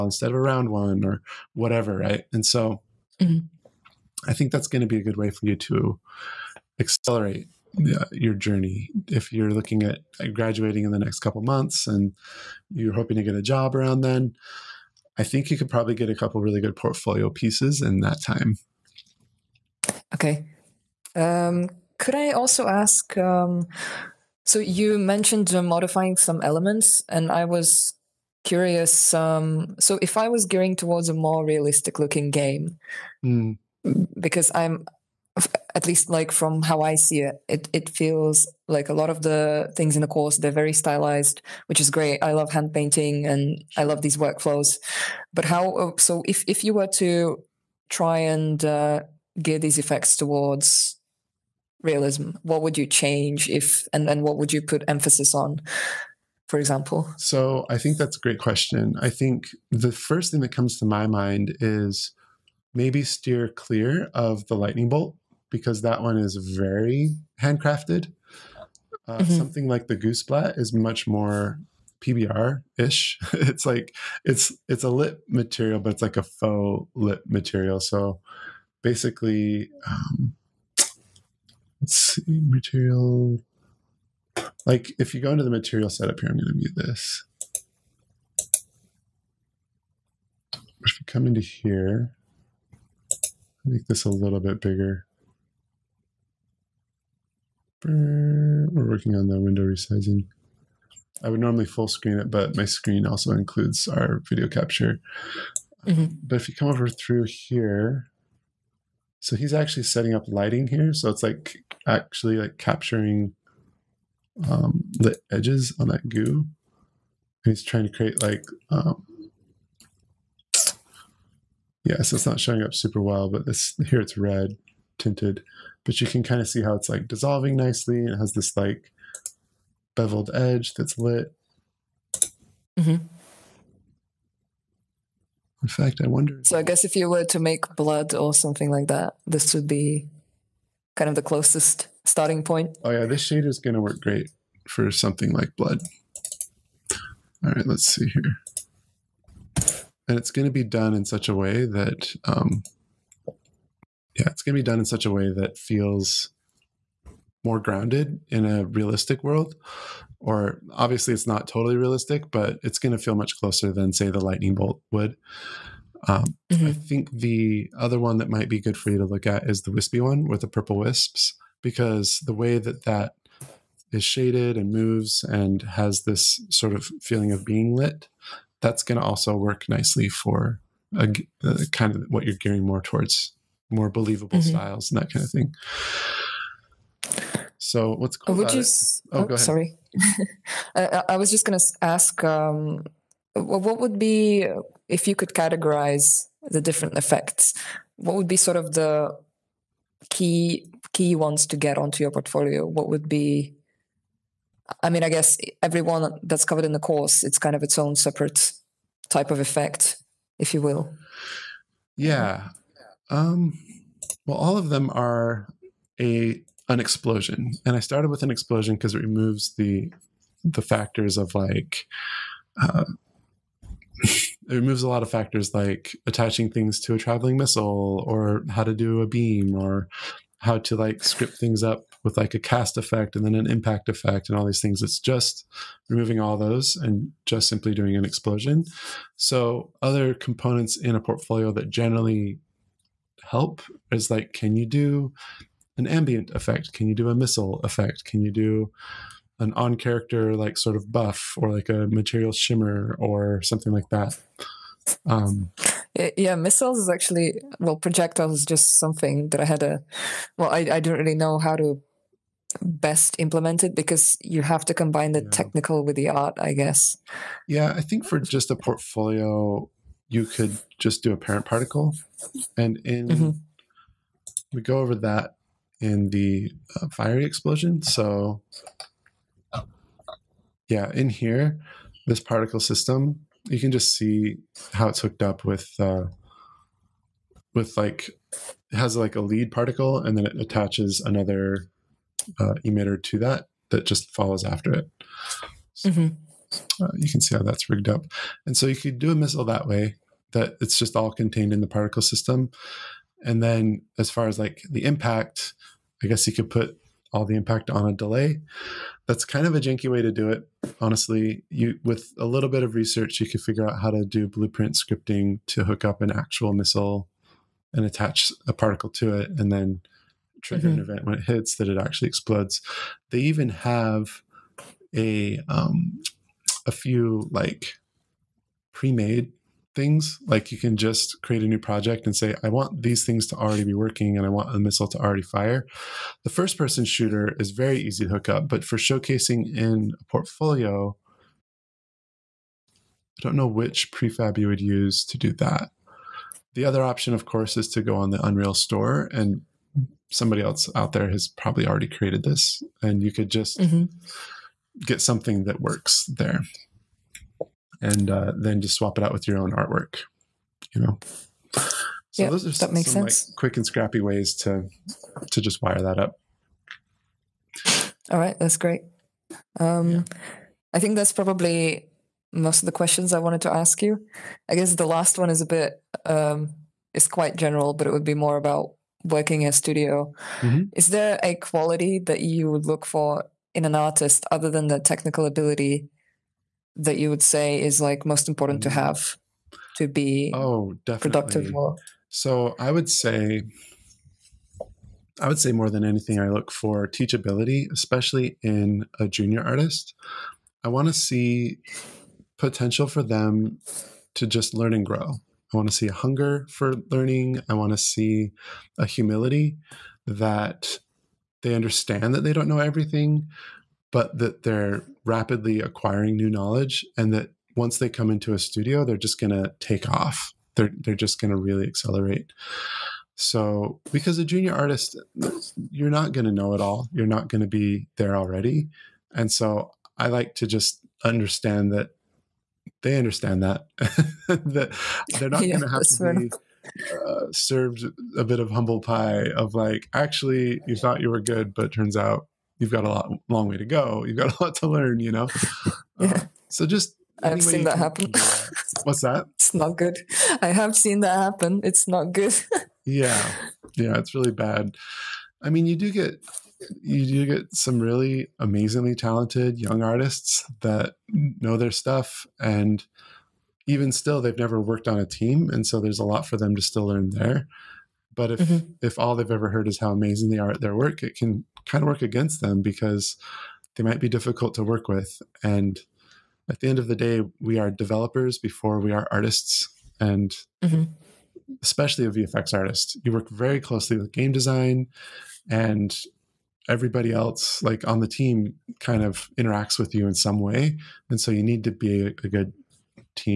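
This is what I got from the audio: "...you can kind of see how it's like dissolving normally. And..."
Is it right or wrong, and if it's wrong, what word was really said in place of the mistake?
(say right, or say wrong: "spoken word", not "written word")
wrong: "nicely", not "normally".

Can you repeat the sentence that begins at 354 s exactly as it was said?
get something that works there and uh, then just swap it out with your own artwork.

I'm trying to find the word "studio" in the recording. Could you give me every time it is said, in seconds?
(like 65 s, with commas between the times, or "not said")
379 s, 418 s.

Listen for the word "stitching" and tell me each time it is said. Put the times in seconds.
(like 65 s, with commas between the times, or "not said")
not said.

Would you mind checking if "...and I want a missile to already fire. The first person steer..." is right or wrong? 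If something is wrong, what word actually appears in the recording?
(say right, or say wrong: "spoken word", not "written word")
wrong: "shooter", not "steer".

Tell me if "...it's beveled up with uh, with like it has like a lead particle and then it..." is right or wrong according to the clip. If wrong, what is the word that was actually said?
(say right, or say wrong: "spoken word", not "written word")
wrong: "hooked", not "beveled".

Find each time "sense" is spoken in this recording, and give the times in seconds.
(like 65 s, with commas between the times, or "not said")
363 s.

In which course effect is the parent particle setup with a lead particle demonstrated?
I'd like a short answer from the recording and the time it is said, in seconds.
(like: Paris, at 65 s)
fiery explosion, at 276 s.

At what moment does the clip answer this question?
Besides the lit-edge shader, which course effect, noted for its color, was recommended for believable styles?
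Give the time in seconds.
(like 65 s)
170 s.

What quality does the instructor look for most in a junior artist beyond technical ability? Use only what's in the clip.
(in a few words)
teachability.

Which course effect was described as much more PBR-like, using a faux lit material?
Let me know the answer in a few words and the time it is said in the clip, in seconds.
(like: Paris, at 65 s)
goo splat, at 69 s.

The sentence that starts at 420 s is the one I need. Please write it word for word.
They're, they're just going to really accelerate.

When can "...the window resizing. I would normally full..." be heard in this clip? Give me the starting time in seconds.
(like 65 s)
99 s.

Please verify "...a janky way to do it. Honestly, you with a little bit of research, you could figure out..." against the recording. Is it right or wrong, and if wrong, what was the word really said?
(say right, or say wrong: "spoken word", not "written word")
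right.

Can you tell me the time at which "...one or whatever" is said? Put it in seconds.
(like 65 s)
0 s.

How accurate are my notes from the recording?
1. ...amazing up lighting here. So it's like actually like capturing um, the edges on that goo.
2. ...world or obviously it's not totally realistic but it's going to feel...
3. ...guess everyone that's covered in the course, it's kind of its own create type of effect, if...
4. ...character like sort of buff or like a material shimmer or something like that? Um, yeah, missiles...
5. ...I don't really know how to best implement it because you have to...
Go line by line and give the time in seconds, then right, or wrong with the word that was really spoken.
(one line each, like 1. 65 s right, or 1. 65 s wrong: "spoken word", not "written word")
1. 109 s wrong: "setting", not "amazing"
2. 159 s right
3. 205 s wrong: "separate", not "create"
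4. 249 s right
5. 260 s right.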